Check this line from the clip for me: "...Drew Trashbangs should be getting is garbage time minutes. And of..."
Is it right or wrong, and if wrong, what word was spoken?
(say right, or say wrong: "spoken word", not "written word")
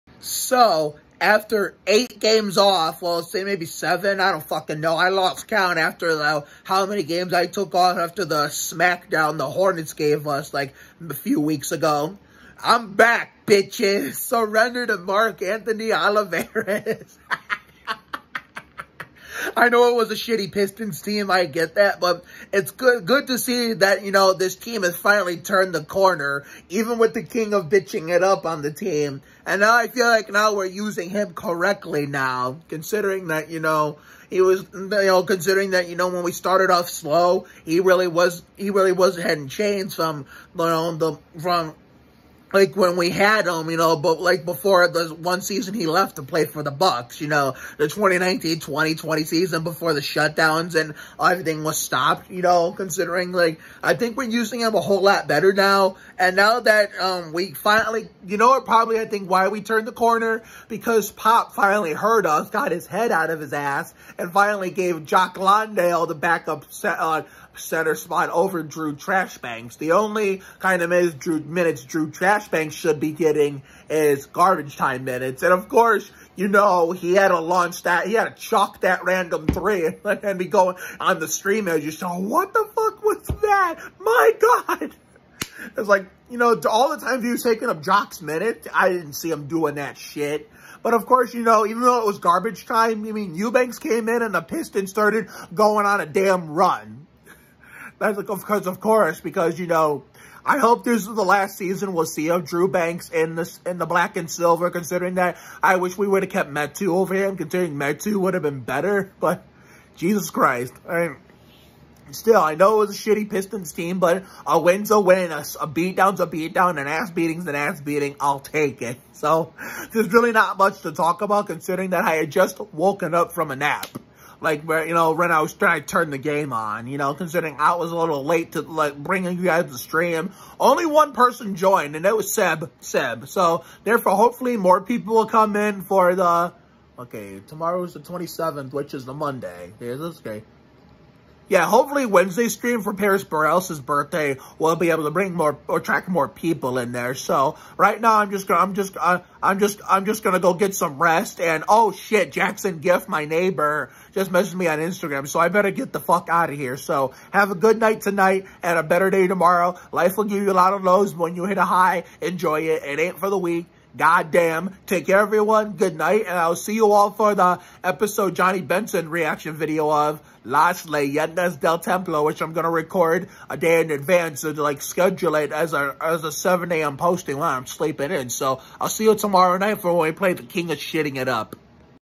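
right.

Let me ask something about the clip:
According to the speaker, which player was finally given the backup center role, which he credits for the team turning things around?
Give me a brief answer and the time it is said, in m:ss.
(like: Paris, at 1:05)
Jock Landale, at 1:05.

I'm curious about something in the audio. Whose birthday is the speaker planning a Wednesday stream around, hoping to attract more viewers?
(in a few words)
Paris Burrell.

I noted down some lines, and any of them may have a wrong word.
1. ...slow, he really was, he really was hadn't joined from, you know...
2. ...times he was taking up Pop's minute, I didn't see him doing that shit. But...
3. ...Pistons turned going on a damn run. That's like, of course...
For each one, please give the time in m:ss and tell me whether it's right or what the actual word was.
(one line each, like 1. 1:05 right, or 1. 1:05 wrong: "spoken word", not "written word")
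1. 0:36 wrong: "changed", not "joined"
2. 1:27 wrong: "Jock", not "Pop"
3. 1:34 wrong: "started", not "turned".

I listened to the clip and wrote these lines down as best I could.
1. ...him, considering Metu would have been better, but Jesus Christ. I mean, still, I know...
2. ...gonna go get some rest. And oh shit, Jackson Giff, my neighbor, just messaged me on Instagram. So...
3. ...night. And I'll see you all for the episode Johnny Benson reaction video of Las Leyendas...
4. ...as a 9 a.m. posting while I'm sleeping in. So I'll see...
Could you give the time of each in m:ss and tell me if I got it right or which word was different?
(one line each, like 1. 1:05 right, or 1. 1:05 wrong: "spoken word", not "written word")
1. 1:47 right
2. 2:30 right
3. 2:45 right
4. 2:56 wrong: "7", not "9".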